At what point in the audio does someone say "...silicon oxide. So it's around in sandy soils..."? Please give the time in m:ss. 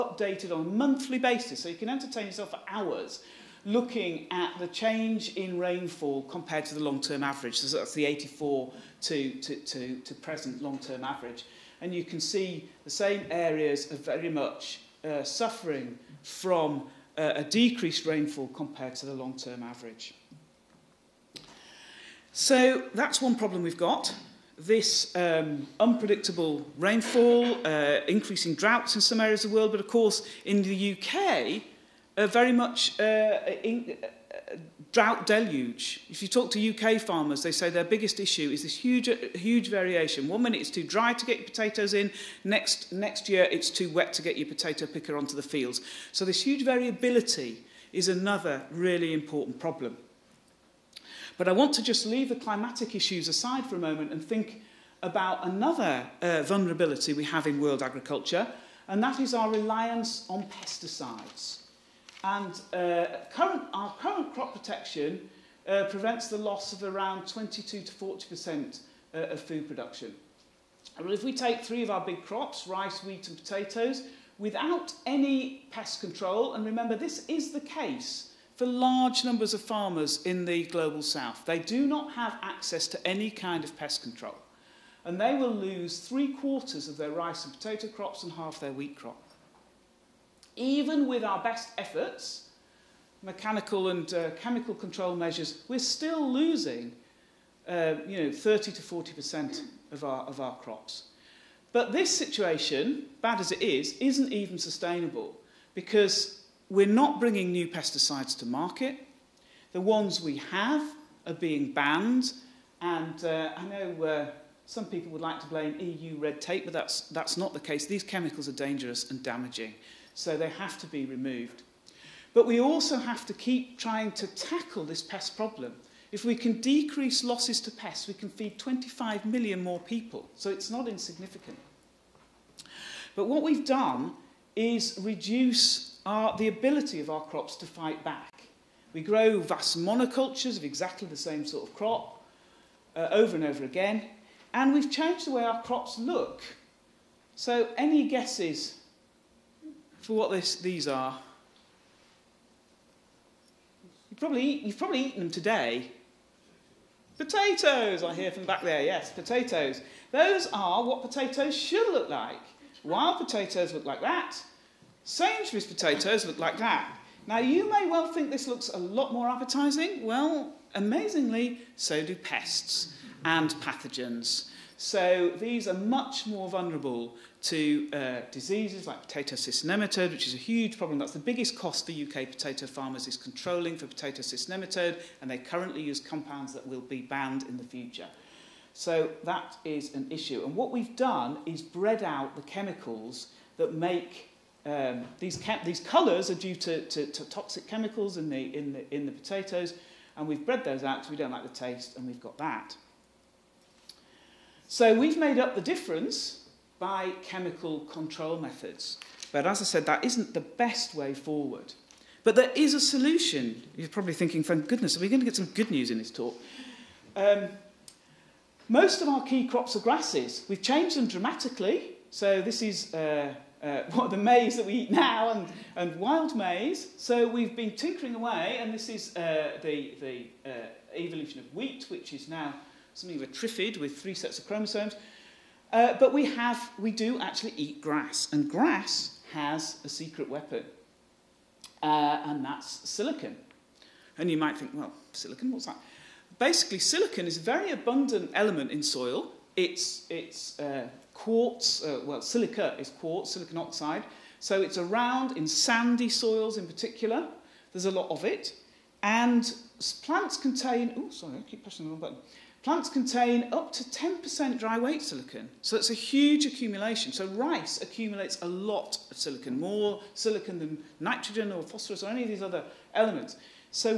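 4:13.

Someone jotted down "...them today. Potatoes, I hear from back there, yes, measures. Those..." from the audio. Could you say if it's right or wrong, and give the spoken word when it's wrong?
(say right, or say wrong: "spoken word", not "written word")
wrong: "potatoes", not "measures".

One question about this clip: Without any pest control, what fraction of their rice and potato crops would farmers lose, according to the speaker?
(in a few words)
three quarters.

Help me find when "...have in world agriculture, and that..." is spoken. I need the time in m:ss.
0:57.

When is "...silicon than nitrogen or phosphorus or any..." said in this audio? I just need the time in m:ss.
4:30.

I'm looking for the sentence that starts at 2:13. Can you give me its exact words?
But what we've done is reduce are the ability of our crops to fight back.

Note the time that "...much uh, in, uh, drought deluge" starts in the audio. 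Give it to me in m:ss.
0:32.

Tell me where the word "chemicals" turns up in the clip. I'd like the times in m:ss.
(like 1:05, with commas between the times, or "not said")
1:34, 1:58, 3:12, 3:17, 3:27.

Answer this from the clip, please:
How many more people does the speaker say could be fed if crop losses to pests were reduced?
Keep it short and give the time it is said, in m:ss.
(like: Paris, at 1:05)
25 million, at 2:08.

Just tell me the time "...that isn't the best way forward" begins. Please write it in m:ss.
3:29.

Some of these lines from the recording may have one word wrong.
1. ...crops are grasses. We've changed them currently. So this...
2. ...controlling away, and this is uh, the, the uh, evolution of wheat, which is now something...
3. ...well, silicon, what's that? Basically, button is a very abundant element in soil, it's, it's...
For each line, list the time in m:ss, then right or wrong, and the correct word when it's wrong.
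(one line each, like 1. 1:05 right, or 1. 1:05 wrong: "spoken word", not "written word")
1. 3:39 wrong: "dramatically", not "currently"
2. 3:47 wrong: "tinkering", not "controlling"
3. 4:04 wrong: "silicon", not "button".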